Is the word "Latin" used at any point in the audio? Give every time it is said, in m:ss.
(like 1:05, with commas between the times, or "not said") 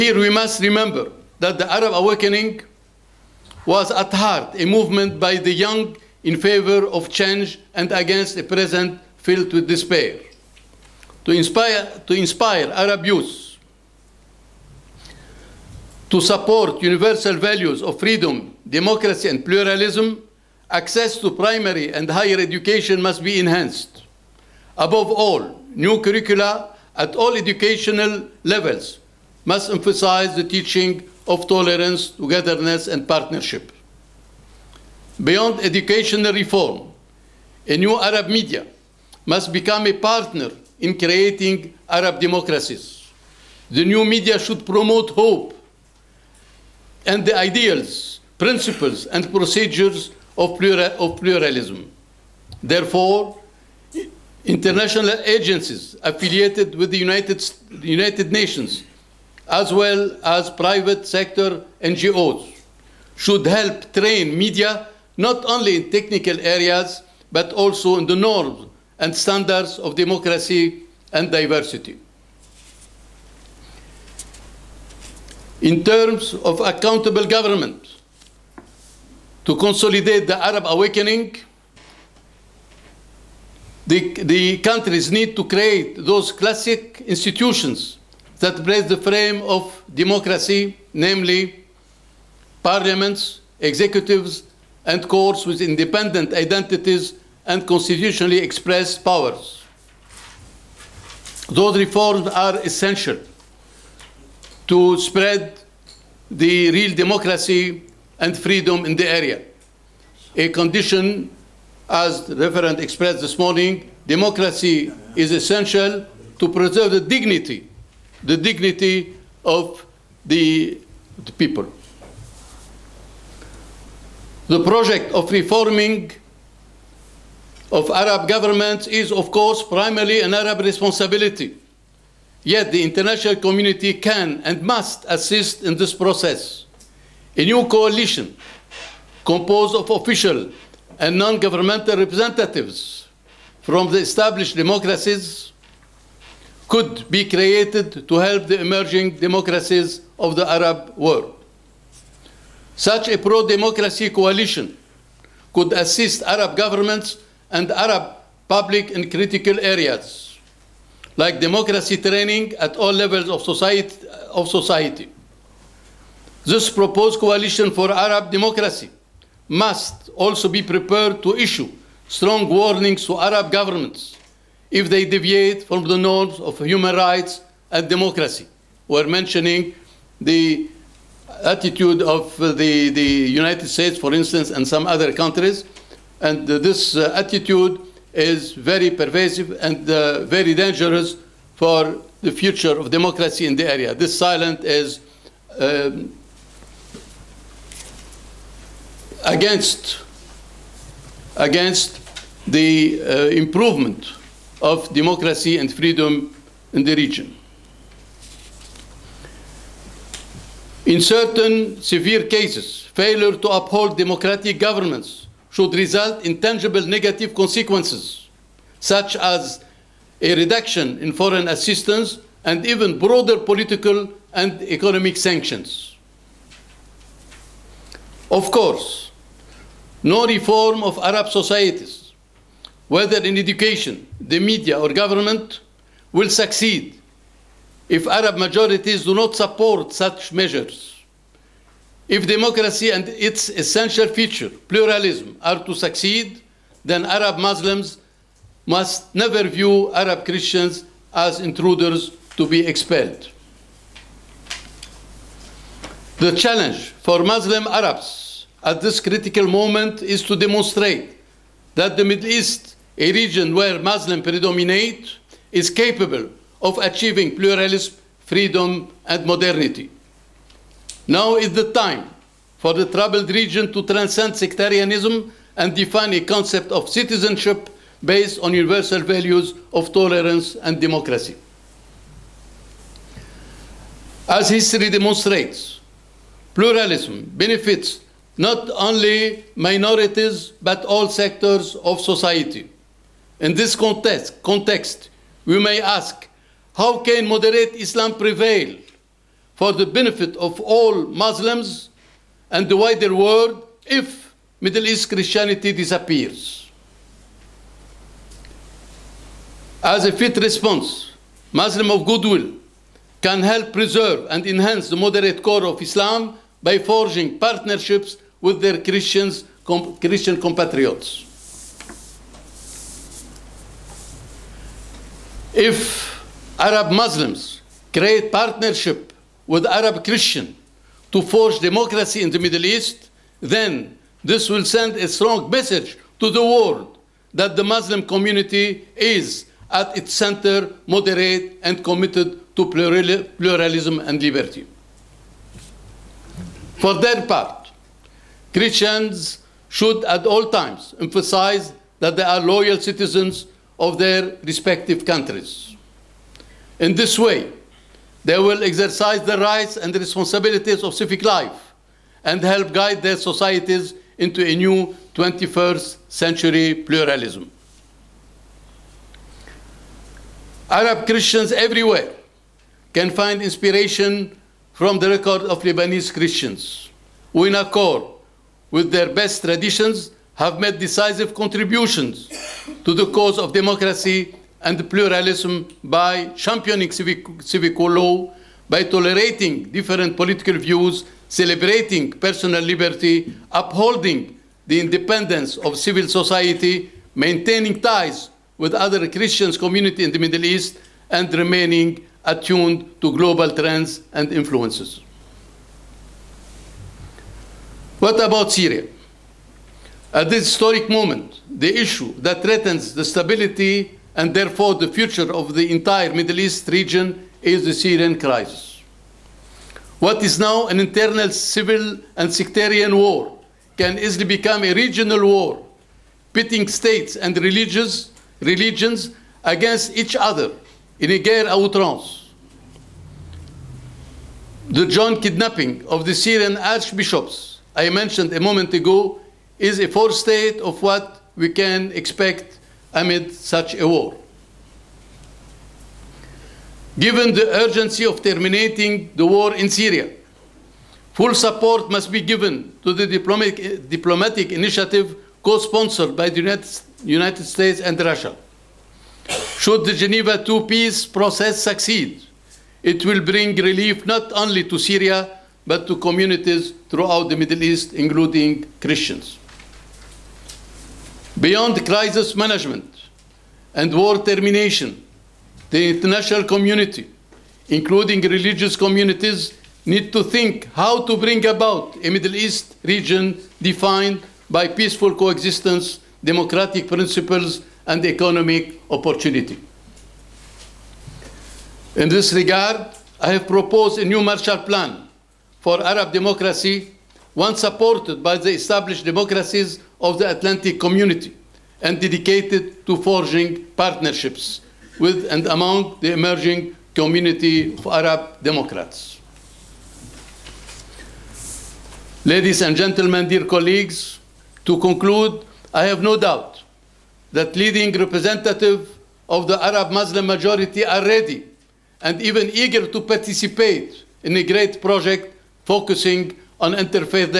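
not said.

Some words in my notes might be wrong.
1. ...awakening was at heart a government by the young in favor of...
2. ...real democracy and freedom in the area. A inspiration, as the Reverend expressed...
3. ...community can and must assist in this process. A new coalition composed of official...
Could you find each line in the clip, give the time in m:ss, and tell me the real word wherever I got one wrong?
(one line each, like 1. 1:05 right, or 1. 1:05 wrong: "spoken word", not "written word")
1. 0:01 wrong: "movement", not "government"
2. 1:46 wrong: "condition", not "inspiration"
3. 2:13 right.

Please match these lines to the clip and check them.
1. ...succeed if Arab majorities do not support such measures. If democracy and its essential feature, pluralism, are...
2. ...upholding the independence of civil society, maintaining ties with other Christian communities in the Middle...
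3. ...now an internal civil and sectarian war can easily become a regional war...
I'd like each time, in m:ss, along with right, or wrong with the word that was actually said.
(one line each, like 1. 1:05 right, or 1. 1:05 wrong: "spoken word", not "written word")
1. 3:56 right
2. 6:33 right
3. 7:00 right.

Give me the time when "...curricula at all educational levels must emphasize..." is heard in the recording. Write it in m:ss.
0:26.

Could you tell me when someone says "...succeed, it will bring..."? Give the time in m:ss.
7:41.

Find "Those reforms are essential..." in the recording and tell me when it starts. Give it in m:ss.
1:41.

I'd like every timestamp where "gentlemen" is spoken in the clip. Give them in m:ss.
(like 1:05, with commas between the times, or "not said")
8:32.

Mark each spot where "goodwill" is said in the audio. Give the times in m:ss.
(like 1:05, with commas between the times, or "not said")
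5:12.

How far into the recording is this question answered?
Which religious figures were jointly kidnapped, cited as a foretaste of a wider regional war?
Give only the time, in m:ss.
7:16.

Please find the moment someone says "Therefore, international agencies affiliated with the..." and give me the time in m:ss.
0:52.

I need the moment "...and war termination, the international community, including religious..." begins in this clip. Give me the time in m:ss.
7:53.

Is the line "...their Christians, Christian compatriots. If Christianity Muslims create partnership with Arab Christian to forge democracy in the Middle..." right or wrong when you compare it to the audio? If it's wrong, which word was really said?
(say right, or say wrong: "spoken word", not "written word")
wrong: "Arab", not "Christianity".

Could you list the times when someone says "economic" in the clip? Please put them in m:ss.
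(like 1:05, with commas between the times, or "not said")
3:44, 8:08.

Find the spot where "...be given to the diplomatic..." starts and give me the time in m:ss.
7:32.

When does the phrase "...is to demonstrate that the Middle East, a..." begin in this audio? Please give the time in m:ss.
4:20.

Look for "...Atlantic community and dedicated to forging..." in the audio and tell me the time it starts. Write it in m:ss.
8:20.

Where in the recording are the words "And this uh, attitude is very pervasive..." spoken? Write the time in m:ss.
3:06.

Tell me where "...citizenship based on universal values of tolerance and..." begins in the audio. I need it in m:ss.
4:36.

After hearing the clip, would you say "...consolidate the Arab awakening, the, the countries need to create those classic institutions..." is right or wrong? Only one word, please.
right.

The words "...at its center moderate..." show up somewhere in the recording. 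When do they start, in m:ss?
5:39.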